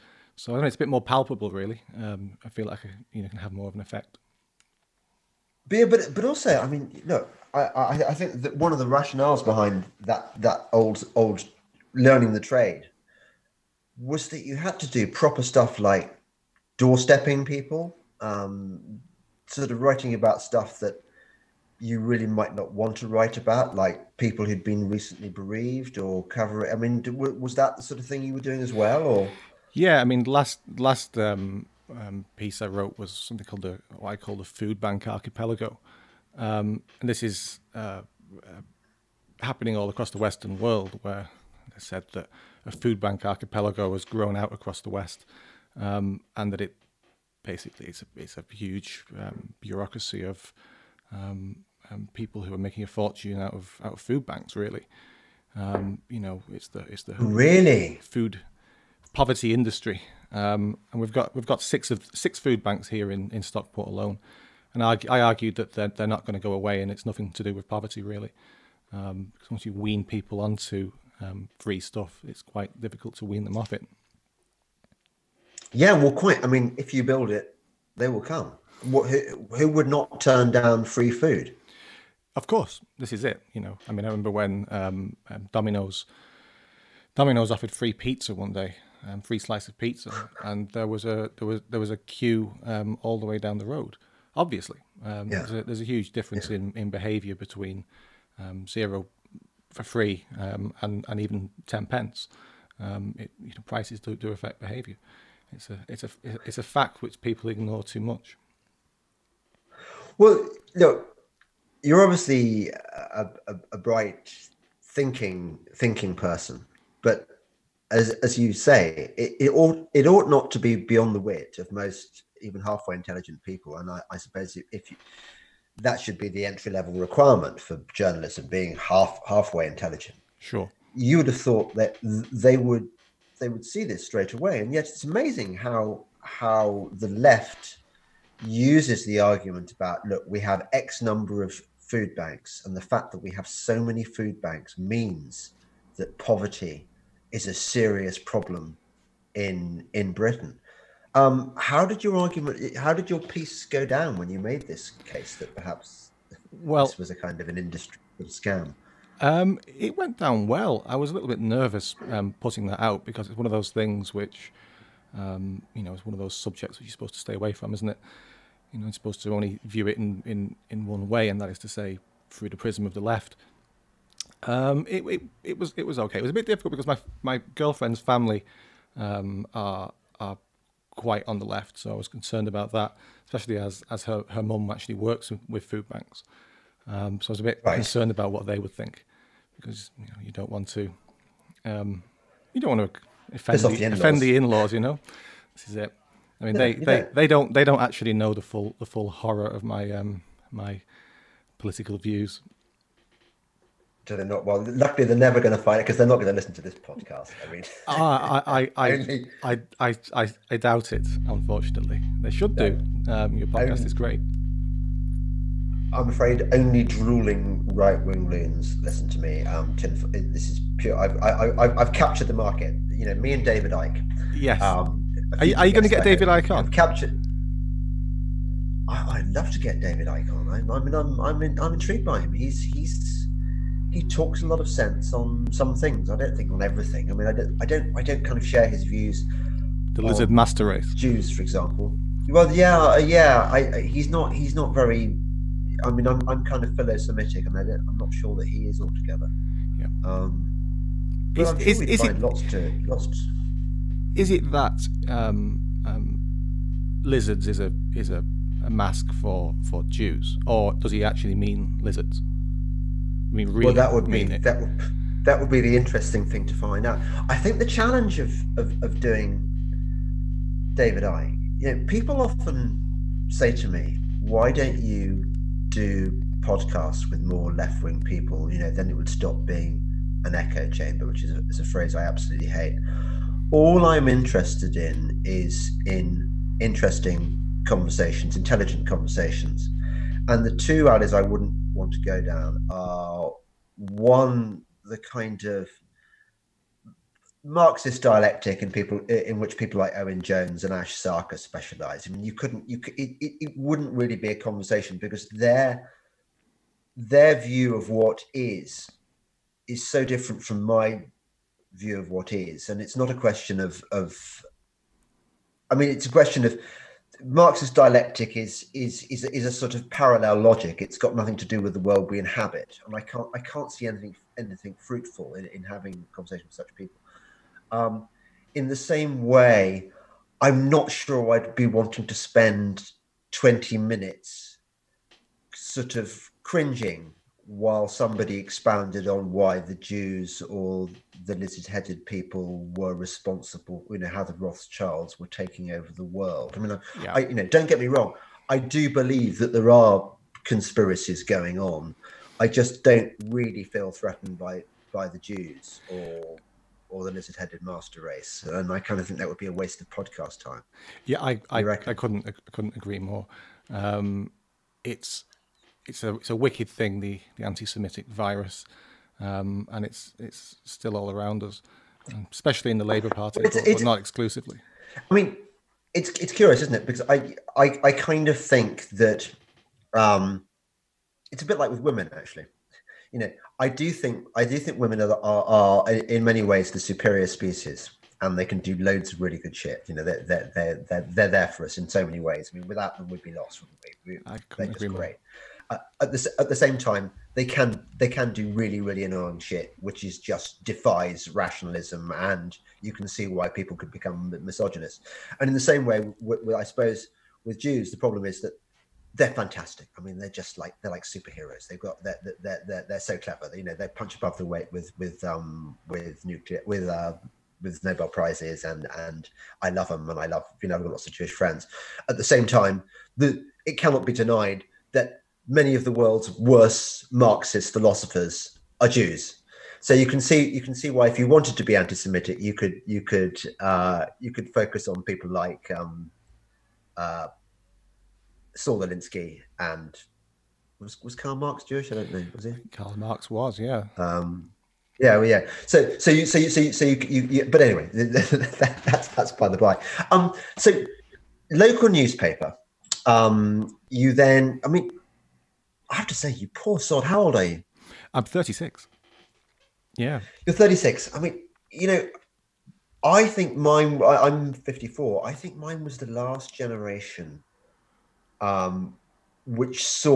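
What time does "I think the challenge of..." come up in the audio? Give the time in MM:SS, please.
04:27.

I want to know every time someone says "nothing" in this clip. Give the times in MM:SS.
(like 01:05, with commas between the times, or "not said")
01:07, 05:21.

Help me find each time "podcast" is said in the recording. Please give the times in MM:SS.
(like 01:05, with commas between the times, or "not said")
03:26, 03:33, 04:36, 05:59.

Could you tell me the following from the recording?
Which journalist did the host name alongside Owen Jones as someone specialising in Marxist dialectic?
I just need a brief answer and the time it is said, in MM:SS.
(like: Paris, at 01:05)
Ash Sarkar, at 05:00.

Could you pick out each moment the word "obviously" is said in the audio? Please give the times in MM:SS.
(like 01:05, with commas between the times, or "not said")
01:34, 01:52.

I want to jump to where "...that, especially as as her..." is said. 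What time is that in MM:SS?
03:02.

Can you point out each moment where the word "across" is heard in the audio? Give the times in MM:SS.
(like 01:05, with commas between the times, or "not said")
00:39, 00:44.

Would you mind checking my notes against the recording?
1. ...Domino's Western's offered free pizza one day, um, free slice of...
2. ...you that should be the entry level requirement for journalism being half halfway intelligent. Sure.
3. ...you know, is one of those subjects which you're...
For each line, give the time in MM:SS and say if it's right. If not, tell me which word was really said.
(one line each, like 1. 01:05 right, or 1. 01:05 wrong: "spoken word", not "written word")
1. 01:25 wrong: "Domino", not "Western"
2. 02:04 right
3. 02:45 right.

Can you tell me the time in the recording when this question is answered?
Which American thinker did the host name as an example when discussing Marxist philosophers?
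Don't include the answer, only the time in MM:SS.
07:18.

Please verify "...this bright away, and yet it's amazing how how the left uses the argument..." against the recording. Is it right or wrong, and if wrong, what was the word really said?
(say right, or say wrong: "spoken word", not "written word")
wrong: "straight", not "bright".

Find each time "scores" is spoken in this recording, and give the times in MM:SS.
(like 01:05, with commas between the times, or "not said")
not said.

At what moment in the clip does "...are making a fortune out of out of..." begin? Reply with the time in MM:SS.
00:52.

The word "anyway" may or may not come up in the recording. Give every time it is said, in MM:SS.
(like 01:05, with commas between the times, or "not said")
07:27.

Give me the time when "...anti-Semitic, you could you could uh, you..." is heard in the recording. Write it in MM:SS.
07:11.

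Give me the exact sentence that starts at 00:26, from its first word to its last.
I mean, was that the sort of thing you were doing as well, or?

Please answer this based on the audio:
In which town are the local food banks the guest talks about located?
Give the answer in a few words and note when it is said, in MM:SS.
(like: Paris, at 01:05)
Stockport, at 01:03.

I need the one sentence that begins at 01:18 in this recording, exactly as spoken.
What, who, who would not turn down free food?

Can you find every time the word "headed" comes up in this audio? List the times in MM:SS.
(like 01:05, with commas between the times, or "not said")
05:41, 05:57.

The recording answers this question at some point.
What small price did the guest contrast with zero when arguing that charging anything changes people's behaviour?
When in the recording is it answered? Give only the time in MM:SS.
01:41.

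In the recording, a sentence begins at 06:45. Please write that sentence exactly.
And in the same way, with, with, I suppose with Jews, the problem is that they're fantastic.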